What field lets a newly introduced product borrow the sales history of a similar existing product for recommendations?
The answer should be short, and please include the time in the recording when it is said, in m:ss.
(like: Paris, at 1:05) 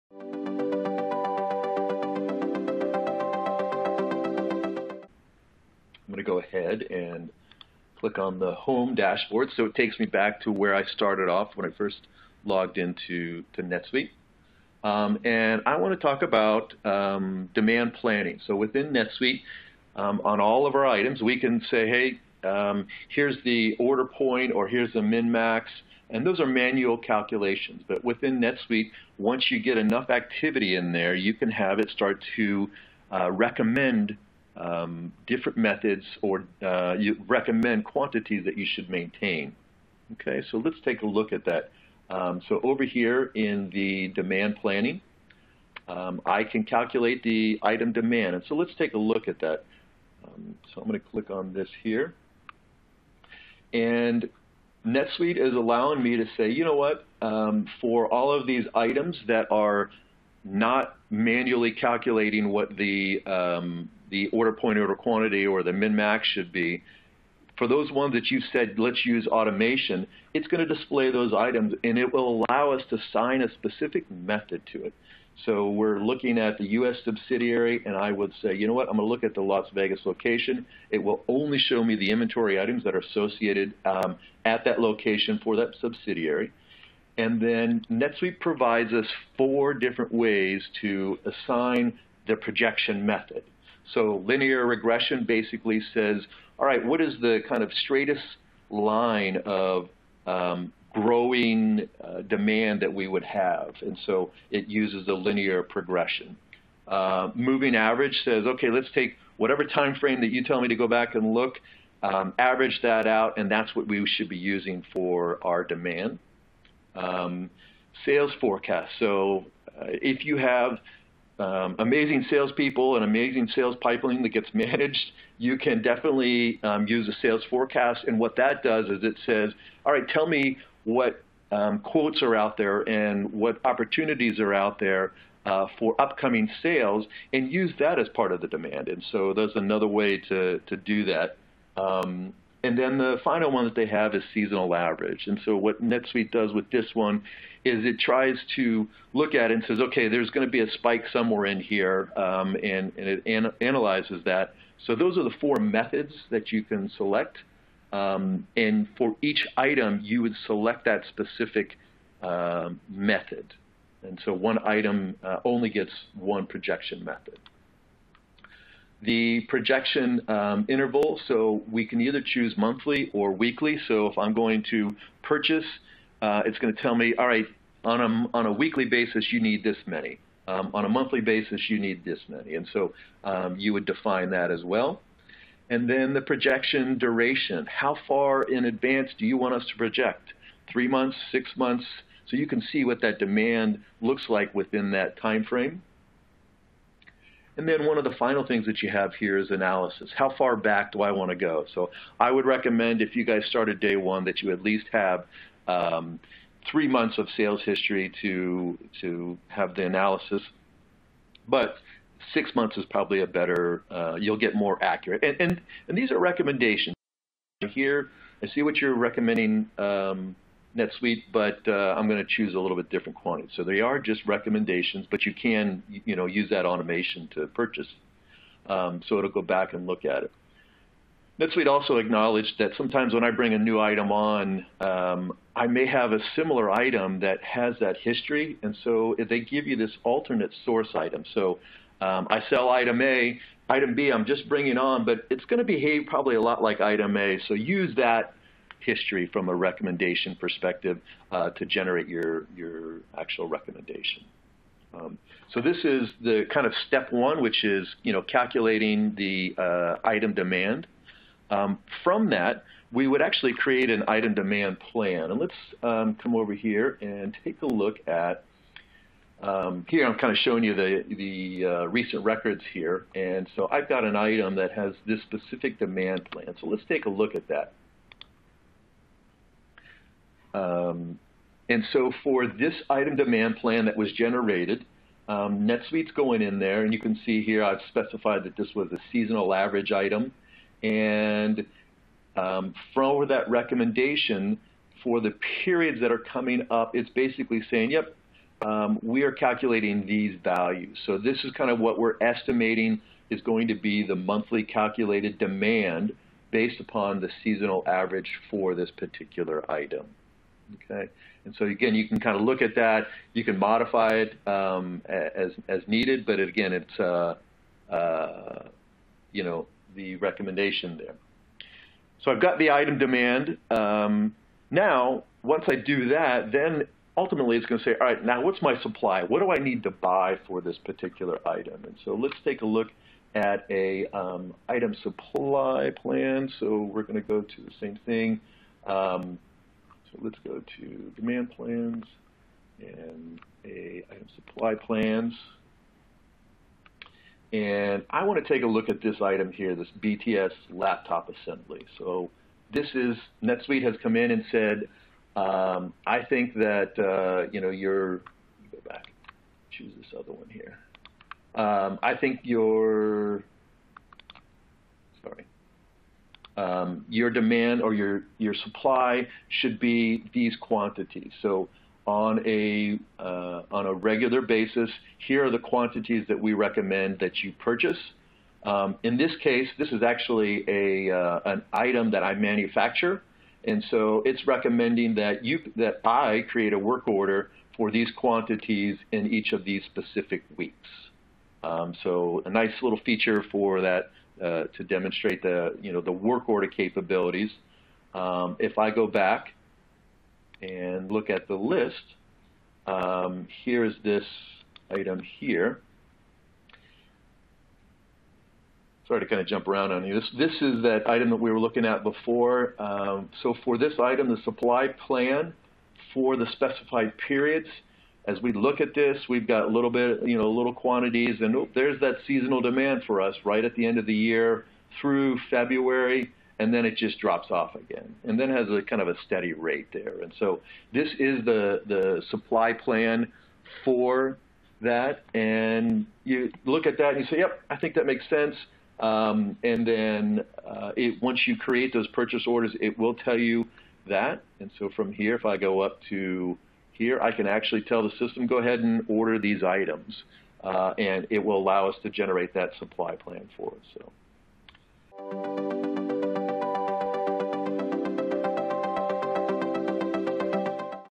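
alternate source item, at 4:00.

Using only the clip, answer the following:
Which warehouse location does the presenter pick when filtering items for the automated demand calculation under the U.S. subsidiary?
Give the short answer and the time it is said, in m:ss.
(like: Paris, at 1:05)
Las Vegas, at 1:19.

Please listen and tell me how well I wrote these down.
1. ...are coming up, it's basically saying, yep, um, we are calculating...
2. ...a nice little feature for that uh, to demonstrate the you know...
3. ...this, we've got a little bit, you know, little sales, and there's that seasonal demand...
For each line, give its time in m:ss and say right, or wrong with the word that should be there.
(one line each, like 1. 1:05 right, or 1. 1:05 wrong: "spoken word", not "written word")
1. 4:56 right
2. 6:32 right
3. 6:58 wrong: "quantities", not "sales".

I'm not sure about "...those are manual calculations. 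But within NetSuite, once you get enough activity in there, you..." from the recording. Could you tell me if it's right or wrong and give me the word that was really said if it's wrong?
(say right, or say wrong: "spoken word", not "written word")
right.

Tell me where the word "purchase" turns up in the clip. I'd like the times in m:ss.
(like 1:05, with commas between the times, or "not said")
2:55, 3:47, 6:17, 7:22.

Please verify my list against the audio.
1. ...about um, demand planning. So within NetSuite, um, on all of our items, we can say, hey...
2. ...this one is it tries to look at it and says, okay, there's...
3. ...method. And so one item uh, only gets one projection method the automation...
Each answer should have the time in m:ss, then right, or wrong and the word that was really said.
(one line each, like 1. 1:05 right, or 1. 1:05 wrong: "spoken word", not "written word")
1. 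0:16 right
2. 2:26 right
3. 2:42 wrong: "projection", not "automation".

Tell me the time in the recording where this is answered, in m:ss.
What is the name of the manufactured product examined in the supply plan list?
5:50.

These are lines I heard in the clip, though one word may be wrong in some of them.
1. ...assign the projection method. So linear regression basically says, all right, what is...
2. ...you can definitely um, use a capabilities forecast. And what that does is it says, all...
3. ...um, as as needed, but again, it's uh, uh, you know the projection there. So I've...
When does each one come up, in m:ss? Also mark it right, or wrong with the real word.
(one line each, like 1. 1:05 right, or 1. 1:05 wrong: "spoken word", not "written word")
1. 1:31 right
2. 2:05 wrong: "sales", not "capabilities"
3. 5:14 wrong: "recommendation", not "projection".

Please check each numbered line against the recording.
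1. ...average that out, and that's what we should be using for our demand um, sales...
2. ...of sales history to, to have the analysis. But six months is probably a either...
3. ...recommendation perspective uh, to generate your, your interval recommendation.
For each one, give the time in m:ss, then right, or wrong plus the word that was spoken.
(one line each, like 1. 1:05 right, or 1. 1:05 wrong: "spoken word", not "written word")
1. 1:52 right
2. 3:27 wrong: "better", not "either"
3. 4:09 wrong: "actual", not "interval".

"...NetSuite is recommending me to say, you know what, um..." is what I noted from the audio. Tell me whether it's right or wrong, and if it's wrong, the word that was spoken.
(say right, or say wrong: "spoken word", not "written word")
wrong: "allowing", not "recommending".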